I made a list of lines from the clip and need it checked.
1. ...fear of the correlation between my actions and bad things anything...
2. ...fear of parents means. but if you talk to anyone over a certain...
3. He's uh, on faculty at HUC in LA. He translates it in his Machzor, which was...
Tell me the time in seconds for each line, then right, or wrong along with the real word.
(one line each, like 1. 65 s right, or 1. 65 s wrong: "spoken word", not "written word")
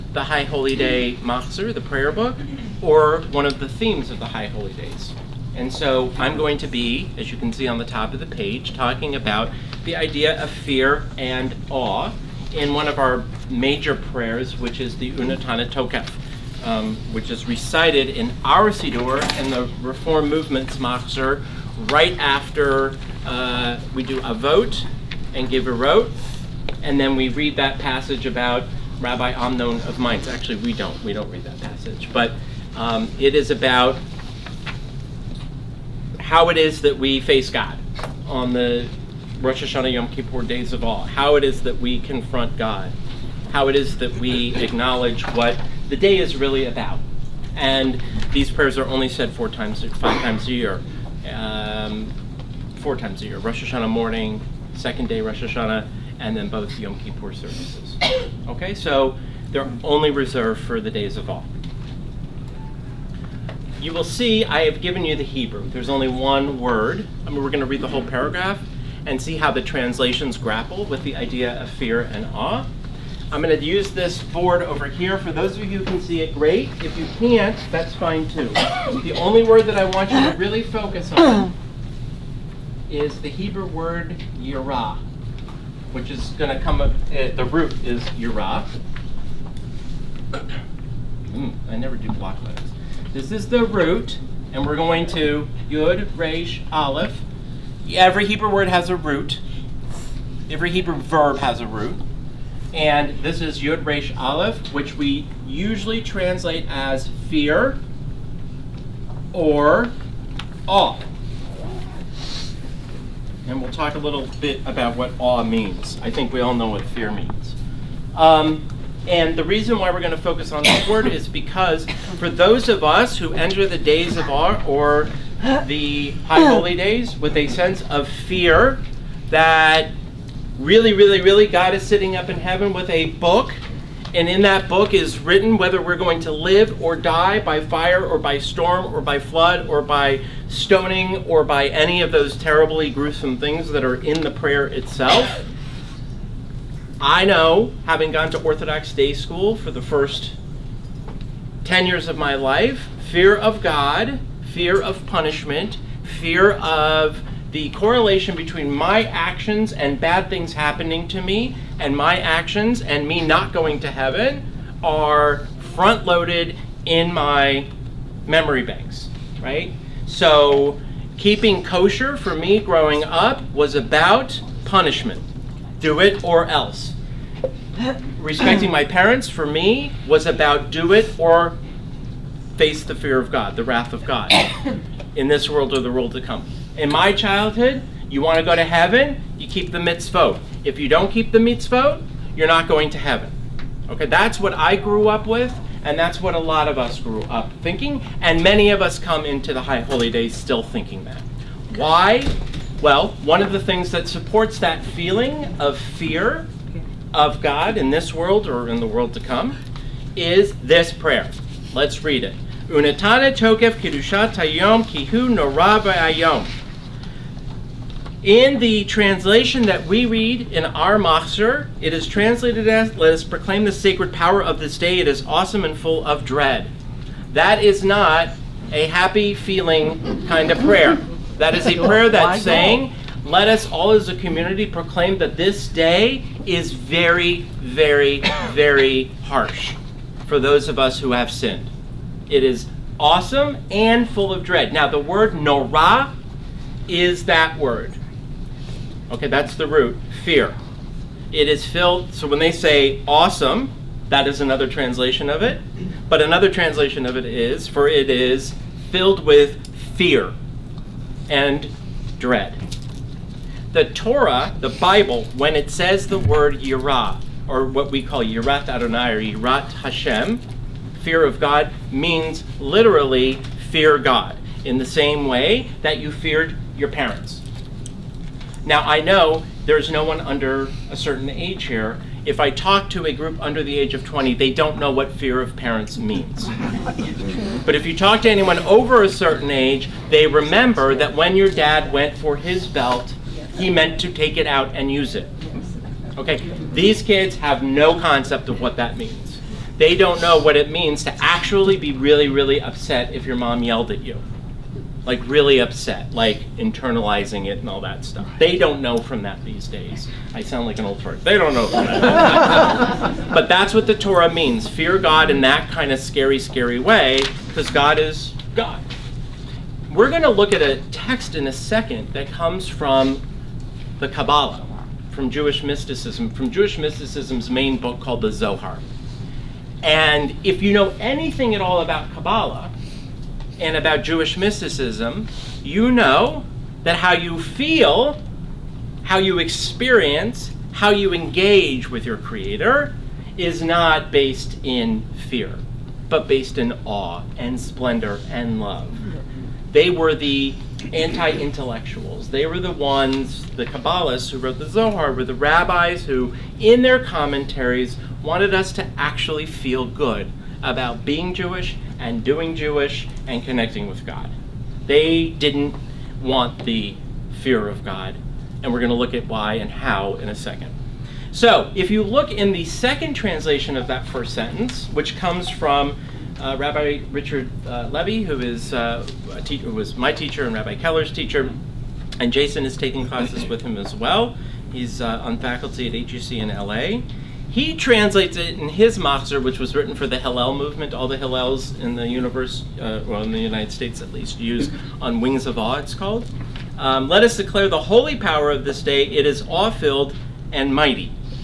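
1. 156 s wrong: "happening", not "anything"
2. 285 s right
3. 384 s right.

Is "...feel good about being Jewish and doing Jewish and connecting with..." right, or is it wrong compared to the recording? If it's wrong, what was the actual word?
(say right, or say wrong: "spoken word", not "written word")
right.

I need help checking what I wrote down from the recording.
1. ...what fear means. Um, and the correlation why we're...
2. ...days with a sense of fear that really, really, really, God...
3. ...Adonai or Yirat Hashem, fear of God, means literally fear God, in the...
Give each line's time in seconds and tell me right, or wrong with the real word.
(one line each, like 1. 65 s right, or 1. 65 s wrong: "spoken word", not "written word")
1. 116 s wrong: "reason", not "correlation"
2. 126 s right
3. 268 s right.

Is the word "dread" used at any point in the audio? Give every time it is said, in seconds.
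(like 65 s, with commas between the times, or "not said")
226 s, 244 s, 262 s.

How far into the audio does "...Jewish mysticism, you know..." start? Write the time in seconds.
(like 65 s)
334 s.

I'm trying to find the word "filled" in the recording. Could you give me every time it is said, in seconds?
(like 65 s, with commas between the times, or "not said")
251 s, 258 s, 399 s.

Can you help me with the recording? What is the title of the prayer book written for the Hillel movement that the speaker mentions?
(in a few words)
On Wings of Awe.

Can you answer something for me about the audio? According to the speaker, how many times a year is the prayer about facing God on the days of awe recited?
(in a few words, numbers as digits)
4.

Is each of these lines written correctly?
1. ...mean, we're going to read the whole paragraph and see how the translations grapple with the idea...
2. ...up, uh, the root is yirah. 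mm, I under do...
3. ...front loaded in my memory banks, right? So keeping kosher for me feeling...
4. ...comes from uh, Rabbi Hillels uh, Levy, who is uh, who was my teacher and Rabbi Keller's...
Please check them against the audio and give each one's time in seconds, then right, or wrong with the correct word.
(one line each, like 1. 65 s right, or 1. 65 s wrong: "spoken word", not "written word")
1. 67 s right
2. 86 s wrong: "never", not "under"
3. 165 s wrong: "growing", not "feeling"
4. 375 s wrong: "Richard", not "Hillels".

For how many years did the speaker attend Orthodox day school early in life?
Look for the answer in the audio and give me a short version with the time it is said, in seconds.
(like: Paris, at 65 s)
10, at 151 s.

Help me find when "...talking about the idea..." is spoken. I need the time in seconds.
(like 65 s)
8 s.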